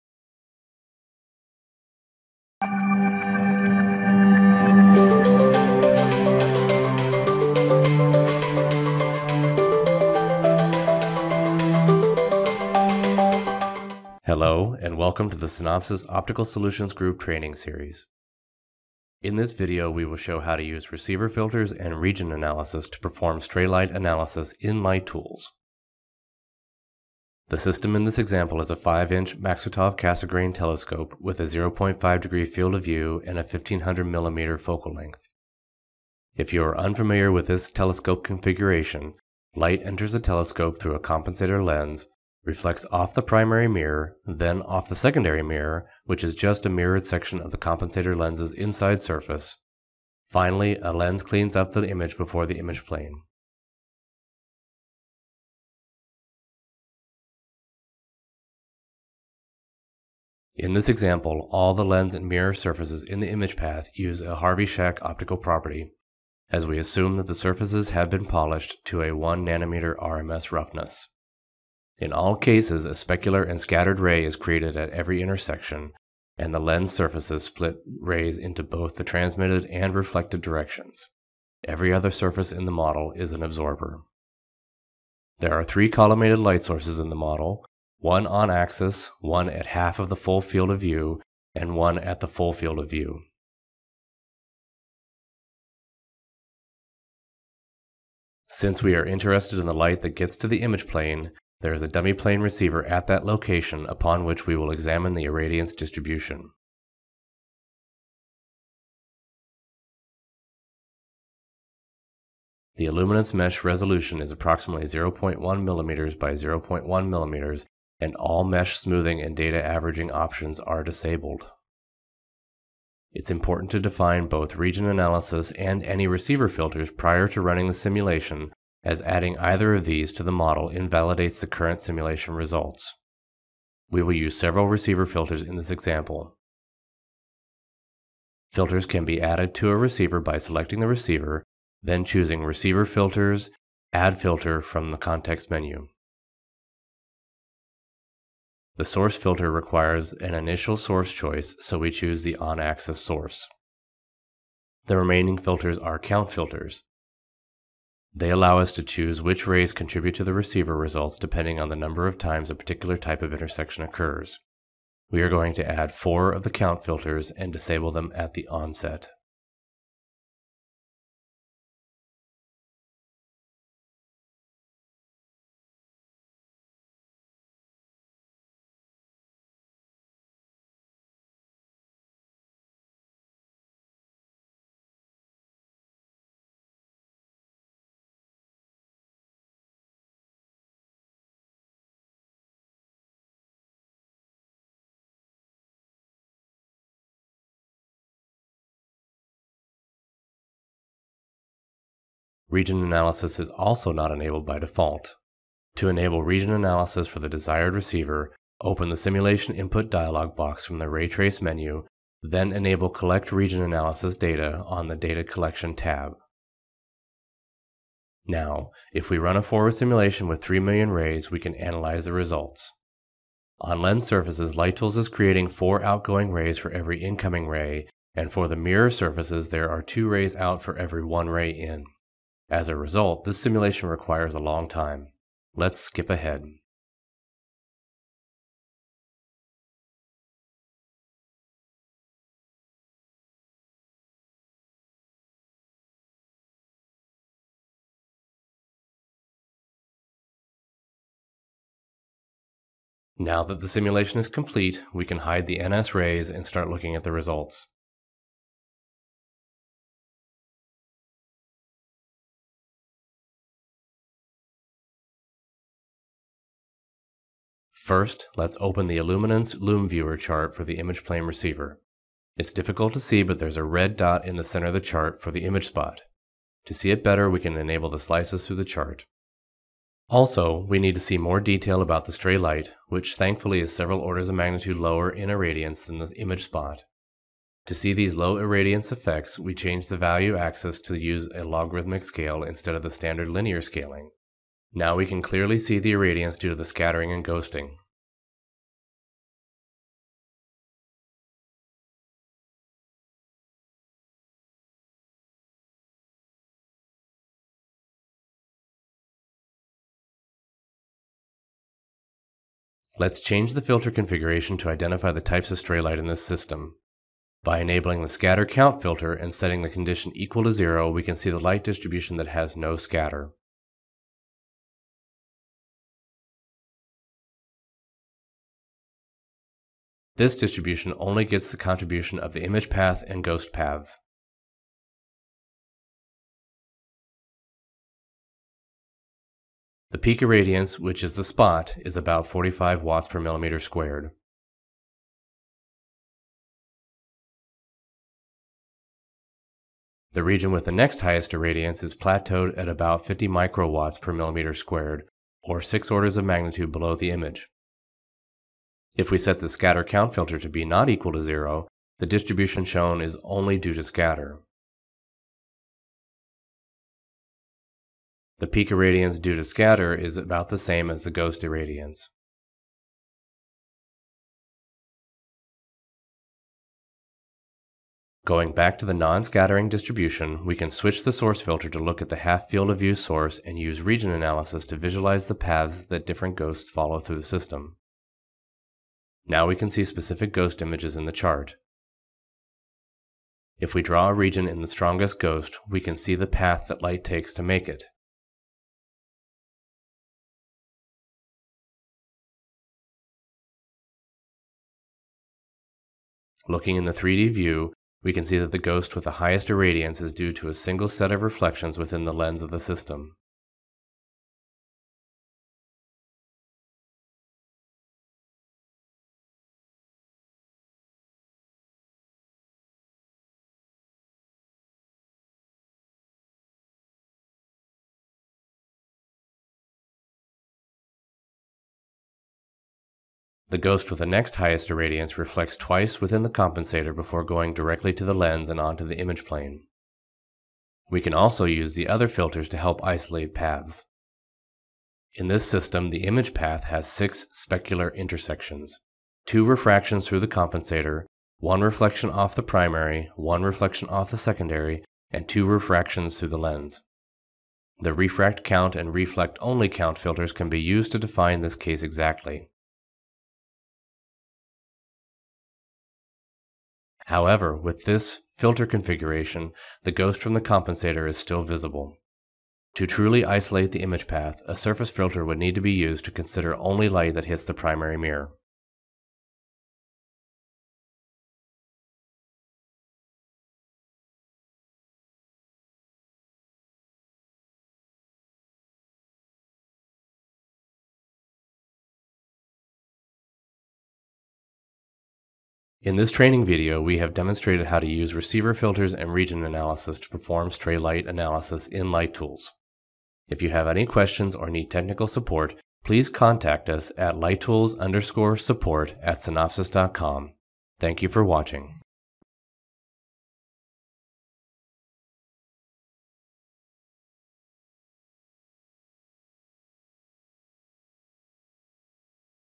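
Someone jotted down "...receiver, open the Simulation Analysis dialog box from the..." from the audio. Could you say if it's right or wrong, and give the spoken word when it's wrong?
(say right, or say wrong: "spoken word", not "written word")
wrong: "Input", not "Analysis".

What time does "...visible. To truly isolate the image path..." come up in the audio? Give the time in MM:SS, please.
07:51.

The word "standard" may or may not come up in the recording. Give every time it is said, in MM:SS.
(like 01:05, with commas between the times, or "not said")
04:52.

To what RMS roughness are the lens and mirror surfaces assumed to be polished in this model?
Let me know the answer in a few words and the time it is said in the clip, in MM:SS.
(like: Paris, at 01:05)
1 nanometer, at 01:09.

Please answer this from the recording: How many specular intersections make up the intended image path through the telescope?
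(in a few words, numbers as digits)
6.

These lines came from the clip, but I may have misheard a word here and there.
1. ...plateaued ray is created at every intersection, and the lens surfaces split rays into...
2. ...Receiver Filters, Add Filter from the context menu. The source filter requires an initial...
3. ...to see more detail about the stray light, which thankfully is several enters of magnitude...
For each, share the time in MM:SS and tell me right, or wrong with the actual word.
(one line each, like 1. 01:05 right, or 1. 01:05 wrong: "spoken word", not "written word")
1. 01:13 wrong: "scattered", not "plateaued"
2. 02:22 right
3. 04:40 wrong: "orders", not "enters".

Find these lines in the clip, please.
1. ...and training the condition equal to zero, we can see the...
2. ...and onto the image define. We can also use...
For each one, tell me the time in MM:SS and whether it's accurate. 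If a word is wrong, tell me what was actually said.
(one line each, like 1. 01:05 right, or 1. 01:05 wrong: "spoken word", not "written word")
1. 05:19 wrong: "setting", not "training"
2. 07:18 wrong: "plane", not "define".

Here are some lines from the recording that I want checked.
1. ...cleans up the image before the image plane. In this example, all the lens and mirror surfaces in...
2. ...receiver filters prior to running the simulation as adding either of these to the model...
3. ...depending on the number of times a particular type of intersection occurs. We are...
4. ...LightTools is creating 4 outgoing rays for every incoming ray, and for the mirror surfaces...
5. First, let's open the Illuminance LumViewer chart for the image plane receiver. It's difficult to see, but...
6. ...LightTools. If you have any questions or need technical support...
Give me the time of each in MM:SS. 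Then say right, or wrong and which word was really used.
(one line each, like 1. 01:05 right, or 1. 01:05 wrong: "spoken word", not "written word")
1. 00:51 right
2. 02:06 right
3. 02:41 right
4. 03:44 right
5. 04:27 right
6. 08:21 right.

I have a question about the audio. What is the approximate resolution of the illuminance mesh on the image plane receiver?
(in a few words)
0.1 mm by 0.1 mm.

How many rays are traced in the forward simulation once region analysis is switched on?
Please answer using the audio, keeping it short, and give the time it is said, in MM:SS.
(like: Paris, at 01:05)
3 million, at 03:40.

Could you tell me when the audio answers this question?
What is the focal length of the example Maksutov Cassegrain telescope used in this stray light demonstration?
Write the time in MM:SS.
00:33.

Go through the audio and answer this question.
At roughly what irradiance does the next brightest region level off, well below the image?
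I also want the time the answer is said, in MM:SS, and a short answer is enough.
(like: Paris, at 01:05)
50 microwatts per mm², at 05:53.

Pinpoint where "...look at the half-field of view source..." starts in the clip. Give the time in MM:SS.
06:21.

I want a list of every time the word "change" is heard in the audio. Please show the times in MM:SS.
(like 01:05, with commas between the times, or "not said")
04:49, 05:13.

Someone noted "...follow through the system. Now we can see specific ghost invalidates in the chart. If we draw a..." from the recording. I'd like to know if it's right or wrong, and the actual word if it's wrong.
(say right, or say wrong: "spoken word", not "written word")
wrong: "images", not "invalidates".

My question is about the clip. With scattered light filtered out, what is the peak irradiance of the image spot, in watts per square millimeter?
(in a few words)
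45.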